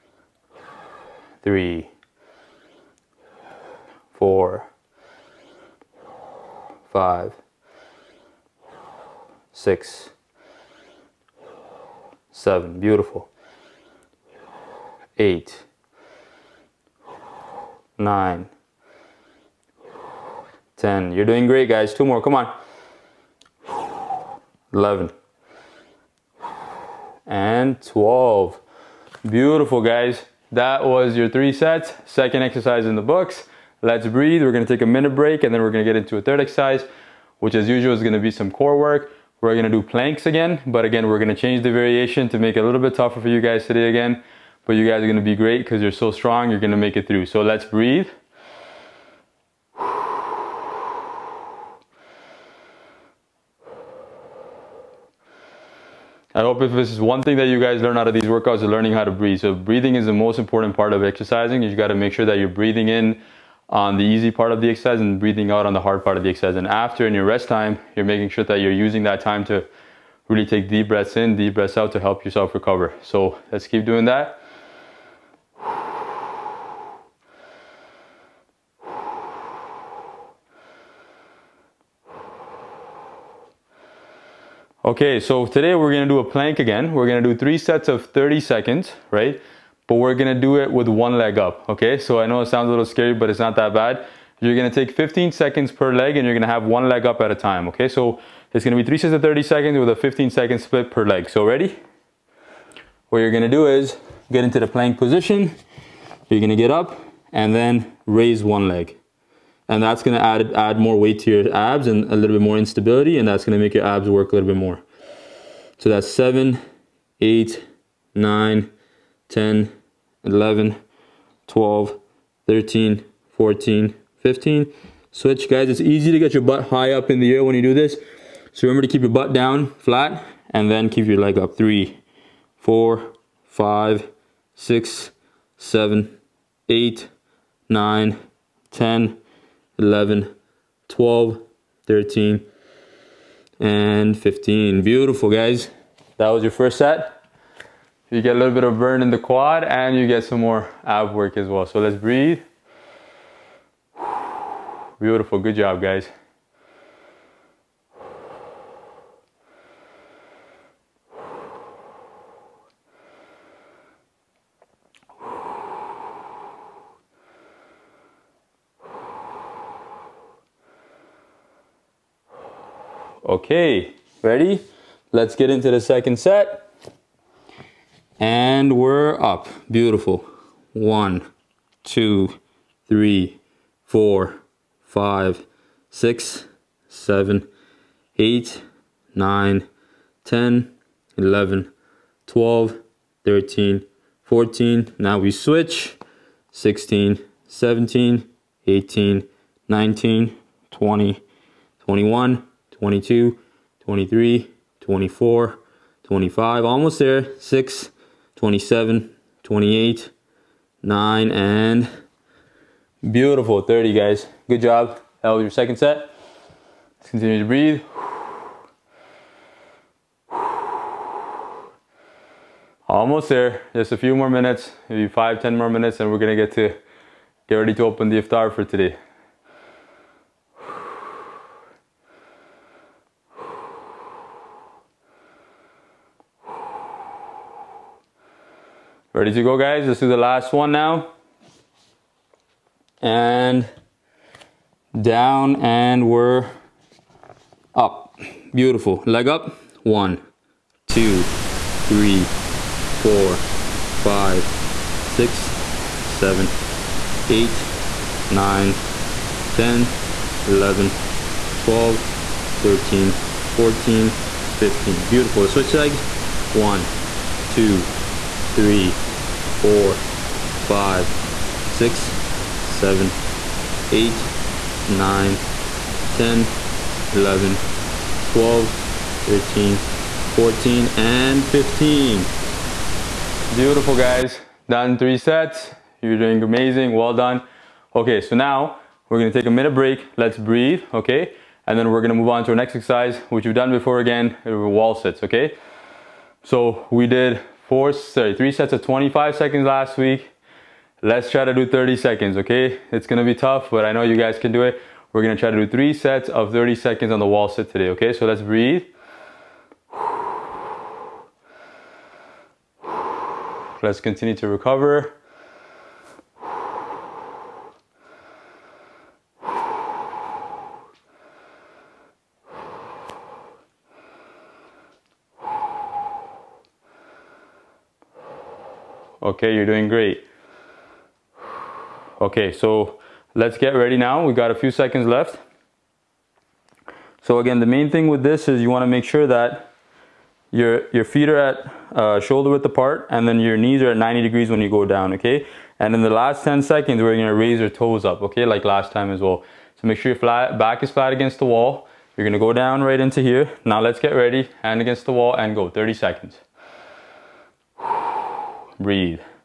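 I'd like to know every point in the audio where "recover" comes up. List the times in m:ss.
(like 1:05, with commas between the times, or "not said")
1:12, 5:14.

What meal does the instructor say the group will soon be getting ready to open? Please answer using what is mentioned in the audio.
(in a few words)
Iftar.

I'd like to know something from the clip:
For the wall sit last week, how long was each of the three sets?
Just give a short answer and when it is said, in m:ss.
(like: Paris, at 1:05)
25 seconds, at 4:58.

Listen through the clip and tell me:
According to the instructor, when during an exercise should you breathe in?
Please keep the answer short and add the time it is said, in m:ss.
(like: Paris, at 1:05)
On the easy part, at 1:04.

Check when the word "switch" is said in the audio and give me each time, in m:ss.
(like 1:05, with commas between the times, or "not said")
2:05, 3:15, 4:25.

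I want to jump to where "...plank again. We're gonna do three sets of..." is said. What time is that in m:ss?
1:26.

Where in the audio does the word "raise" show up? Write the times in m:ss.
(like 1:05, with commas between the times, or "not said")
1:48, 5:47.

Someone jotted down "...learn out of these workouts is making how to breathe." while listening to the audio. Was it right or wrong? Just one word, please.
wrong.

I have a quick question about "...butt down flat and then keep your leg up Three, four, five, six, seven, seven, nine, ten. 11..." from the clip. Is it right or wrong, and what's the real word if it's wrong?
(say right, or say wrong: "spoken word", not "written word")
wrong: "eight", not "seven".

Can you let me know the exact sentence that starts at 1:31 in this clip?
So I know it sounds a little scary, but it's not that bad.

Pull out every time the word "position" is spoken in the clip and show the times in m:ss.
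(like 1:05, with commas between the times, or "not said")
1:44.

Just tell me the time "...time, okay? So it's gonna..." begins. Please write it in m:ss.
1:37.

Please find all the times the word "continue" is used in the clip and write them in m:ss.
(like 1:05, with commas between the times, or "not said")
3:37, 5:14.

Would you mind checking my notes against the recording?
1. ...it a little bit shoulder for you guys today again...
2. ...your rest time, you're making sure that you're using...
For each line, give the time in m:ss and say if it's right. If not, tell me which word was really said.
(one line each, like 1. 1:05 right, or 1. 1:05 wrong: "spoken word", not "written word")
1. 0:42 wrong: "tougher", not "shoulder"
2. 1:07 right.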